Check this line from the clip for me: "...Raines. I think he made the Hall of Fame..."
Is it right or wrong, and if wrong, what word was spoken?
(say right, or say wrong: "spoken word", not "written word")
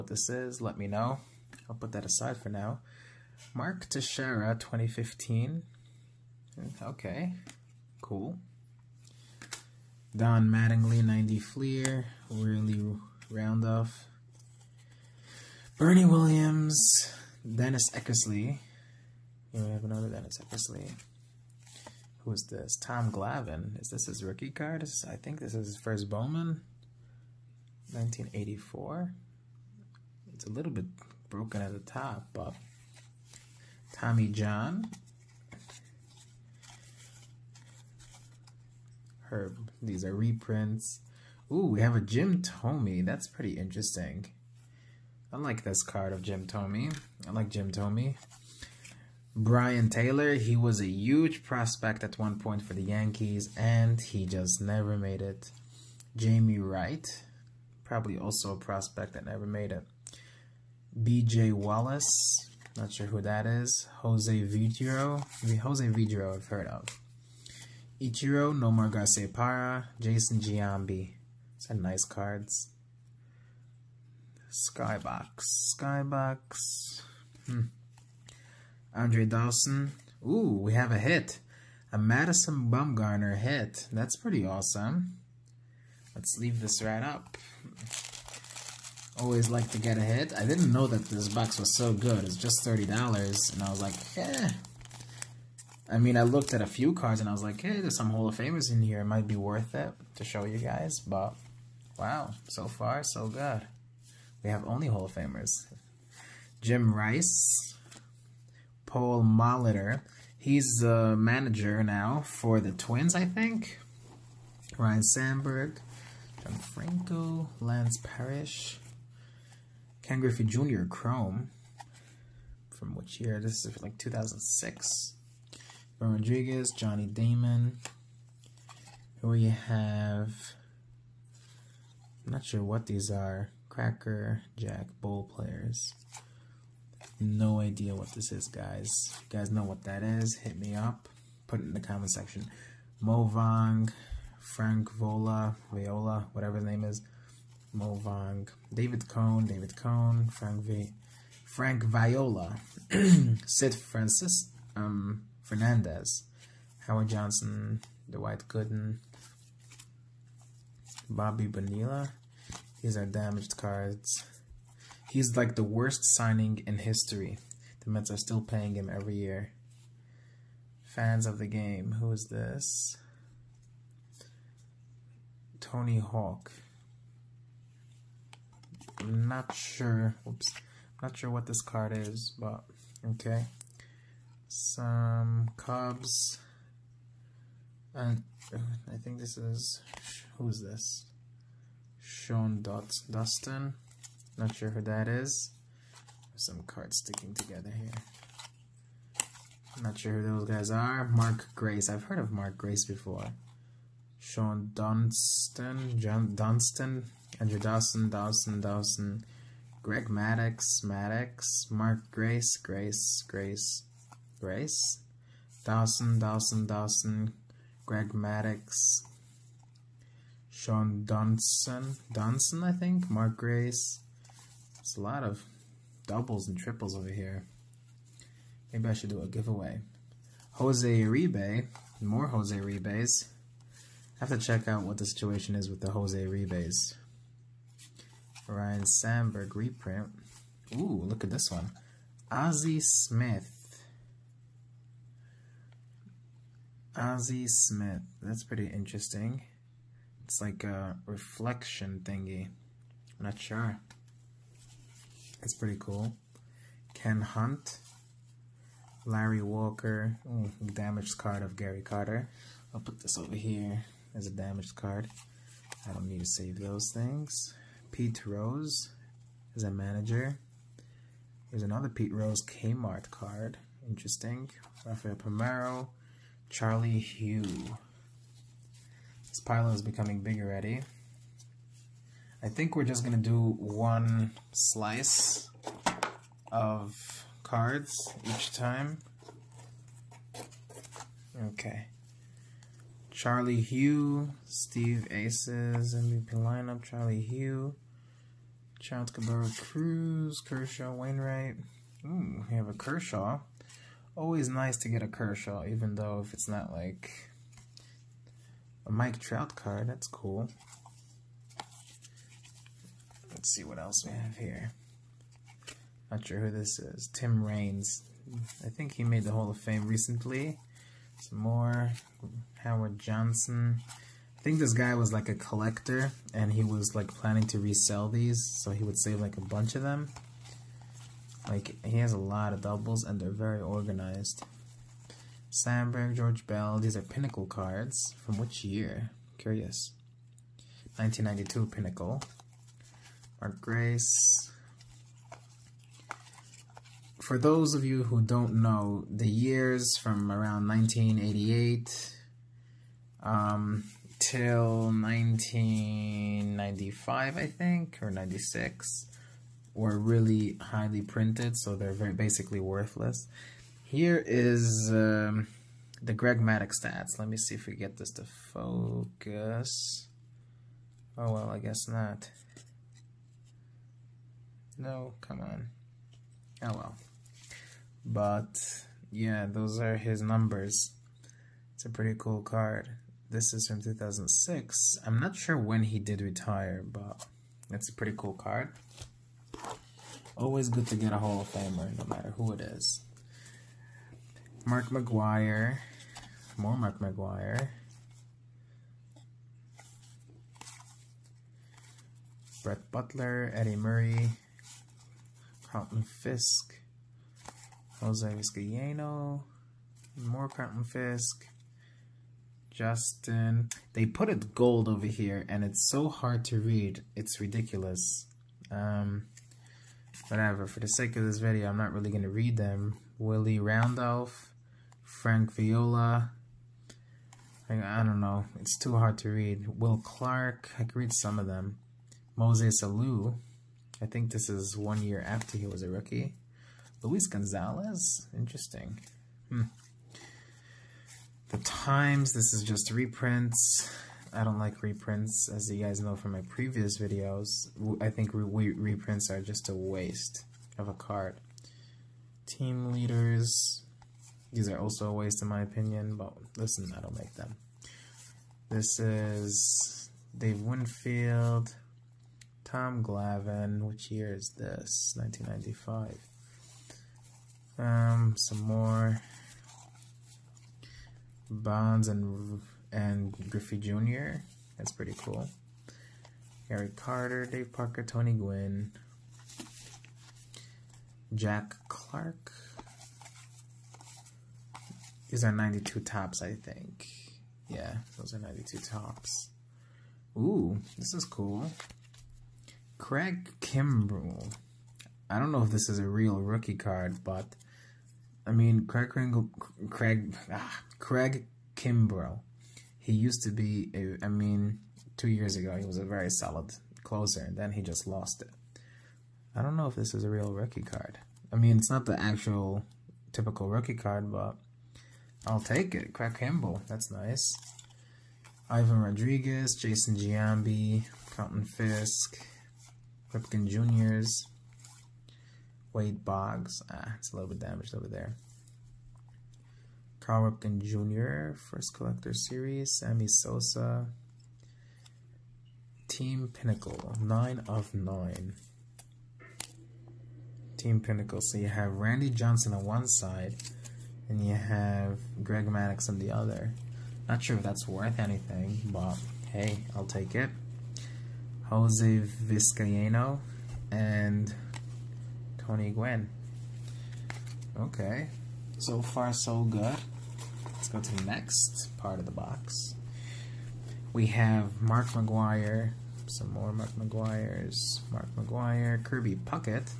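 right.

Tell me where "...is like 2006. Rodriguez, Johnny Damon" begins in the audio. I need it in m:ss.
2:03.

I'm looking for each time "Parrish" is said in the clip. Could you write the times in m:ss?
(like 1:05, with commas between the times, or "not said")
1:58.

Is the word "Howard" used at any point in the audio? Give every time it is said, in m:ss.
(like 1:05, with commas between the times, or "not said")
2:36, 5:22.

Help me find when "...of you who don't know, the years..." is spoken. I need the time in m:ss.
5:47.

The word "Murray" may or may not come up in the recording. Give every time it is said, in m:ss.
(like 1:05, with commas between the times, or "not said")
6:43.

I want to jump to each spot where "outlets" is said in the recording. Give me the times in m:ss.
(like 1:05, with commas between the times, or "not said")
not said.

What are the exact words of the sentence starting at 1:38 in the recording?
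It might be worth it to show you guys, but wow, so far, so good.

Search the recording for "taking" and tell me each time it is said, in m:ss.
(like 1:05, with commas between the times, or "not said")
not said.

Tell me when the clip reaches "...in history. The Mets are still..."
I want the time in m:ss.
2:46.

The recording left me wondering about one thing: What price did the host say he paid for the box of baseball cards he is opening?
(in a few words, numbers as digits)
$30.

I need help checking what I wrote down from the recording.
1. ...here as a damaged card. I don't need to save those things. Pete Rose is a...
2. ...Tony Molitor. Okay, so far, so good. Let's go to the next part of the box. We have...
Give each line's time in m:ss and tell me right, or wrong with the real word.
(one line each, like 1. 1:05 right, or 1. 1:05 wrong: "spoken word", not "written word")
1. 4:23 right
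2. 9:15 wrong: "Gwynn", not "Molitor".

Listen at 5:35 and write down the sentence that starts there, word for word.
Sandberg, George Bell, these are pinnacle cards.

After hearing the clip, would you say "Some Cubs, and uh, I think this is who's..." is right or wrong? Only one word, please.
right.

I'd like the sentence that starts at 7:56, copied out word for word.
Harry Carter, Dave Parker, Tony Gwynn, Jack Clark.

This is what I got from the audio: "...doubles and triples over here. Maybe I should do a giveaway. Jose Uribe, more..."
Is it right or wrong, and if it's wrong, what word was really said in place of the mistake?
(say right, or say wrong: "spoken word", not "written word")
right.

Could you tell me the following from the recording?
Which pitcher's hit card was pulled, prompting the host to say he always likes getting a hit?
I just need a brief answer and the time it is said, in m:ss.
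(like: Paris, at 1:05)
Madison Bumgarner, at 1:21.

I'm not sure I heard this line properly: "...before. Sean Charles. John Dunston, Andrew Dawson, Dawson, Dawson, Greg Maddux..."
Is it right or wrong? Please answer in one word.
wrong.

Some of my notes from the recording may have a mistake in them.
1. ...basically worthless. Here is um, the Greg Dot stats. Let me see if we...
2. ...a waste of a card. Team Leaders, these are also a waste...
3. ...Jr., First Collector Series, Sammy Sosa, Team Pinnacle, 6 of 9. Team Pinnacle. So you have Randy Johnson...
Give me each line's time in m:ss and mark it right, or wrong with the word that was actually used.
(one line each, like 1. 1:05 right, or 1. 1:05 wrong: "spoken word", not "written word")
1. 6:02 wrong: "Maddux", not "Dot"
2. 7:29 right
3. 8:50 wrong: "9", not "6".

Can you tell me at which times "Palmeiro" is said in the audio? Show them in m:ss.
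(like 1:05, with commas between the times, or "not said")
4:35.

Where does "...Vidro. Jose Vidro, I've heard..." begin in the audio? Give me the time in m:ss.
1:04.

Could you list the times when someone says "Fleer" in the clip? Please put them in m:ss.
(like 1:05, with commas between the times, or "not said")
0:11.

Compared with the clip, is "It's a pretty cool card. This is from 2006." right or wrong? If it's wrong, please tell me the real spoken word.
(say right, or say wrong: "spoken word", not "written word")
right.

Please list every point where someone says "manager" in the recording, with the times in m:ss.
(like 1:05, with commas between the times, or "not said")
1:51, 4:29.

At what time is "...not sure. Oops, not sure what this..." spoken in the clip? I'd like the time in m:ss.
2:59.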